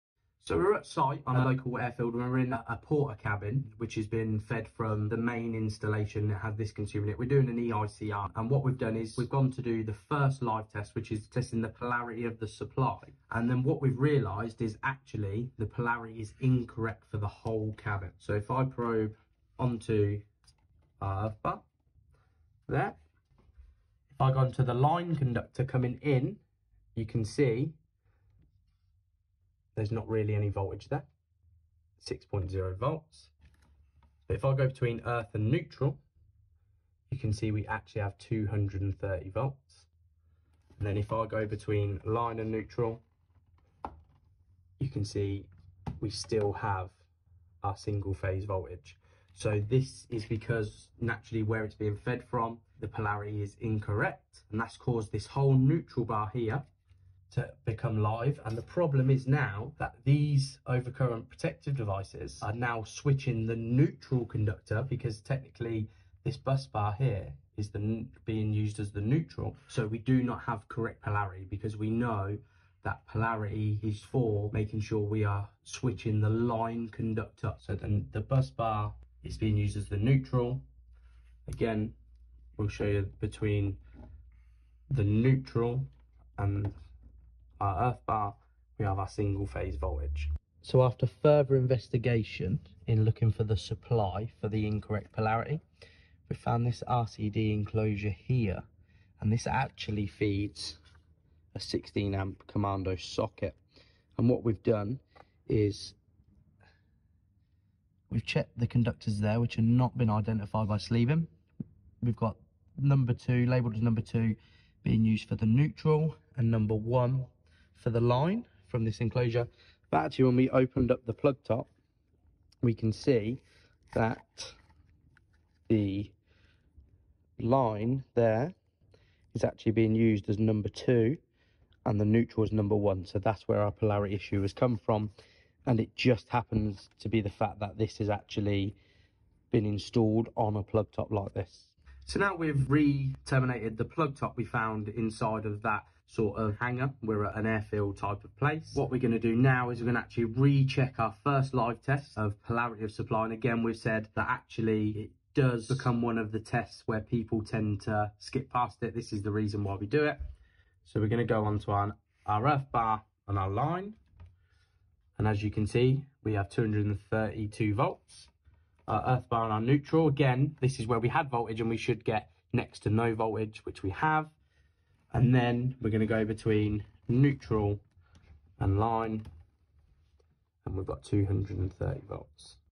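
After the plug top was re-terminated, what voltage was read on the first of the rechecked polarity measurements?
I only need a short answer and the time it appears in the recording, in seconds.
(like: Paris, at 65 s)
232 volts, at 166 s.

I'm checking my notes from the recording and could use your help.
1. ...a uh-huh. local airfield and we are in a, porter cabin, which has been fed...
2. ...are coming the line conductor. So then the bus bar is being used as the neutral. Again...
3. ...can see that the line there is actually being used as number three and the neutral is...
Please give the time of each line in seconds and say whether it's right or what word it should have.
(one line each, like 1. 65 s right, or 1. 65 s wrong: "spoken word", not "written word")
1. 1 s right
2. 75 s wrong: "switching", not "coming"
3. 122 s wrong: "two", not "three".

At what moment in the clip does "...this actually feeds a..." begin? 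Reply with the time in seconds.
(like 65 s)
99 s.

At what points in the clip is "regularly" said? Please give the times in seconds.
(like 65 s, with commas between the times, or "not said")
not said.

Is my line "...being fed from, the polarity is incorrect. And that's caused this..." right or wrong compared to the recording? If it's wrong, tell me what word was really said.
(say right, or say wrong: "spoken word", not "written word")
right.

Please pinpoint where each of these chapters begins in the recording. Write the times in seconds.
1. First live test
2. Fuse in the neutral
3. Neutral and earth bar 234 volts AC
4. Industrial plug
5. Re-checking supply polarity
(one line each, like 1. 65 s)
1. 10 s
2. 60 s
3. 84 s
4. 101 s
5. 142 s.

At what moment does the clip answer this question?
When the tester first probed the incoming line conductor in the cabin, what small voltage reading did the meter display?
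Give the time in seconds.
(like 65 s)
32 s.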